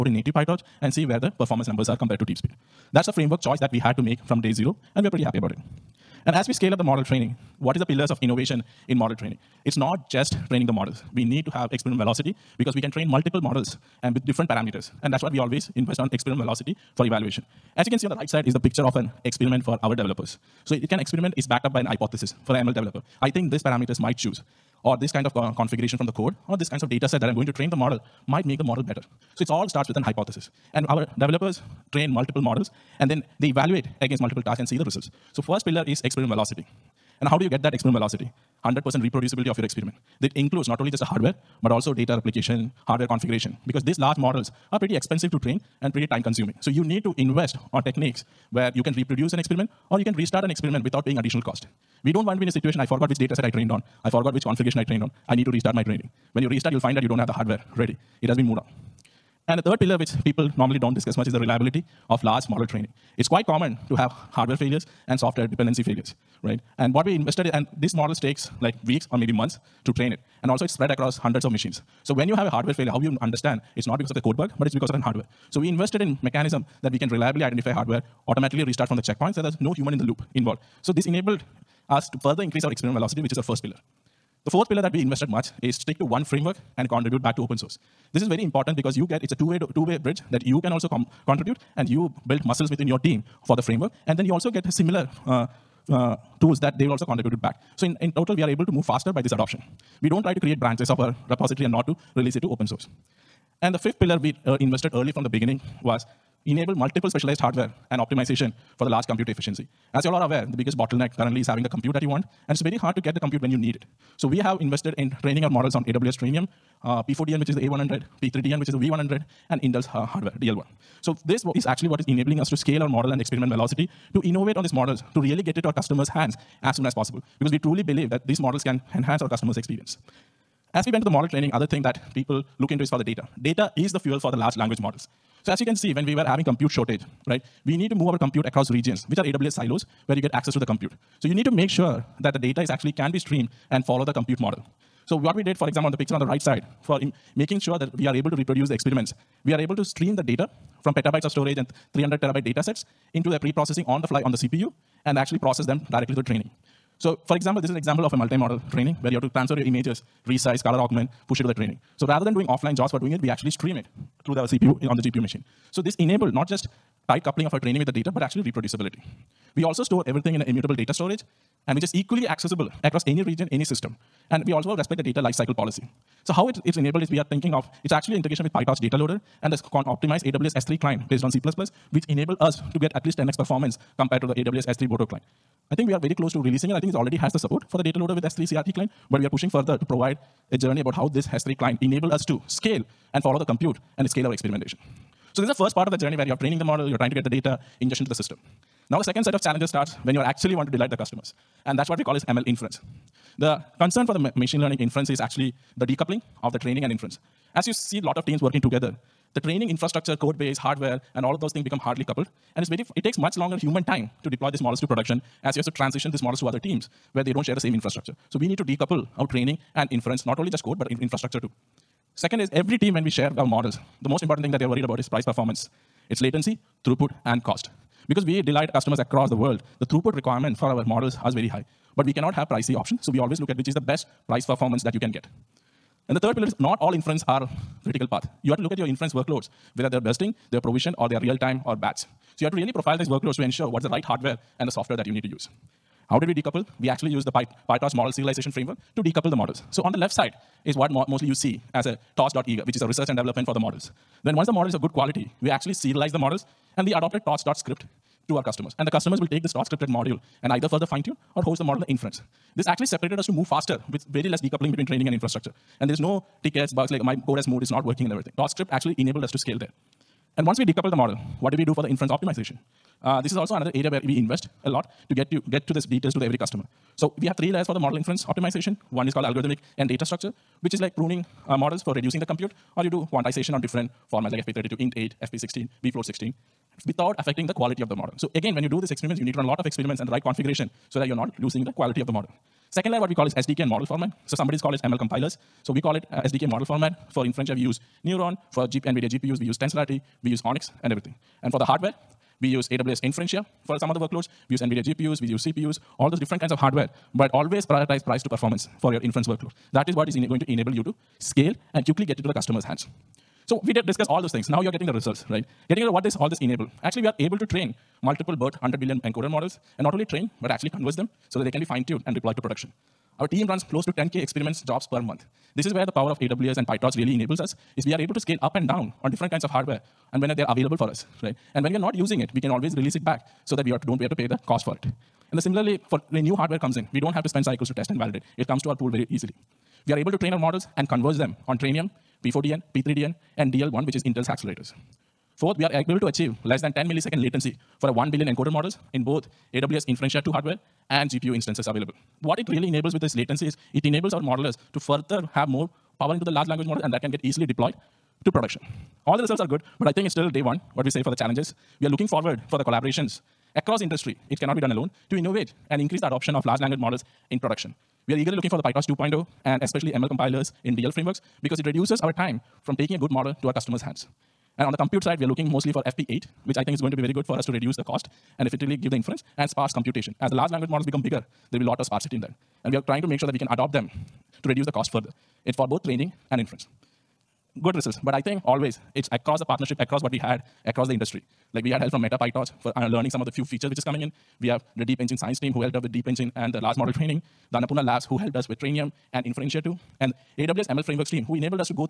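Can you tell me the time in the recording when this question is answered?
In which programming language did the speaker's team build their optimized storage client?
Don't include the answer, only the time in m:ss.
3:01.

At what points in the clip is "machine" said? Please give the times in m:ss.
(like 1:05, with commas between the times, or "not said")
1:11, 2:45, 3:24.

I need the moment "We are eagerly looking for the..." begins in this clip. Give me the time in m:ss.
6:08.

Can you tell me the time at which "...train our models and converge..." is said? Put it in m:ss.
5:40.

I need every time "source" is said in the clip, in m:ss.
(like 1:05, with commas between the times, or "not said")
1:27, 1:42.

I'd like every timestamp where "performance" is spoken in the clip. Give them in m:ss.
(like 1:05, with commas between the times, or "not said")
0:01, 3:03, 3:45, 3:54, 5:08.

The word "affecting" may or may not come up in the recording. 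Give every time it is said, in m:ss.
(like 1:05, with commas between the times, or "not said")
4:47.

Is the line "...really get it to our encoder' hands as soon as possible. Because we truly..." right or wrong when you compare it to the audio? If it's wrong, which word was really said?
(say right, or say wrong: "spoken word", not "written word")
wrong: "customers", not "encoder".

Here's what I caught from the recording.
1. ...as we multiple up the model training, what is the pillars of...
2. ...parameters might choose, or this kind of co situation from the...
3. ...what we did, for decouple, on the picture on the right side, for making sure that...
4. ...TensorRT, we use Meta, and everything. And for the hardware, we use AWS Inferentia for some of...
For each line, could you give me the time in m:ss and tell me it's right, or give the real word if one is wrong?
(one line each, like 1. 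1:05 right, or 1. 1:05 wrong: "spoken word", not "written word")
1. 0:06 wrong: "scale", not "multiple"
2. 0:23 wrong: "configuration", not "situation"
3. 2:25 wrong: "example", not "decouple"
4. 4:59 wrong: "ONNX", not "Meta".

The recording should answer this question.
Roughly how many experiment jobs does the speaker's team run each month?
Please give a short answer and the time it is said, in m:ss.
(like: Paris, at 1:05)
10K, at 5:23.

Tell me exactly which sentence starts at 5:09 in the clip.
That is what is going to enable you to scale and quickly get it to the customer's hands.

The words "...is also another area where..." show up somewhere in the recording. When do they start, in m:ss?
4:33.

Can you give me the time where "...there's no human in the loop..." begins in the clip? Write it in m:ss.
1:19.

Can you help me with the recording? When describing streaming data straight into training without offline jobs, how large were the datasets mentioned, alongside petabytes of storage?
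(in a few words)
300 terabytes.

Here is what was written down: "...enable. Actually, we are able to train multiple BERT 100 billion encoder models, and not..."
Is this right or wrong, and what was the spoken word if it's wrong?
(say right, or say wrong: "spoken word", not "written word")
right.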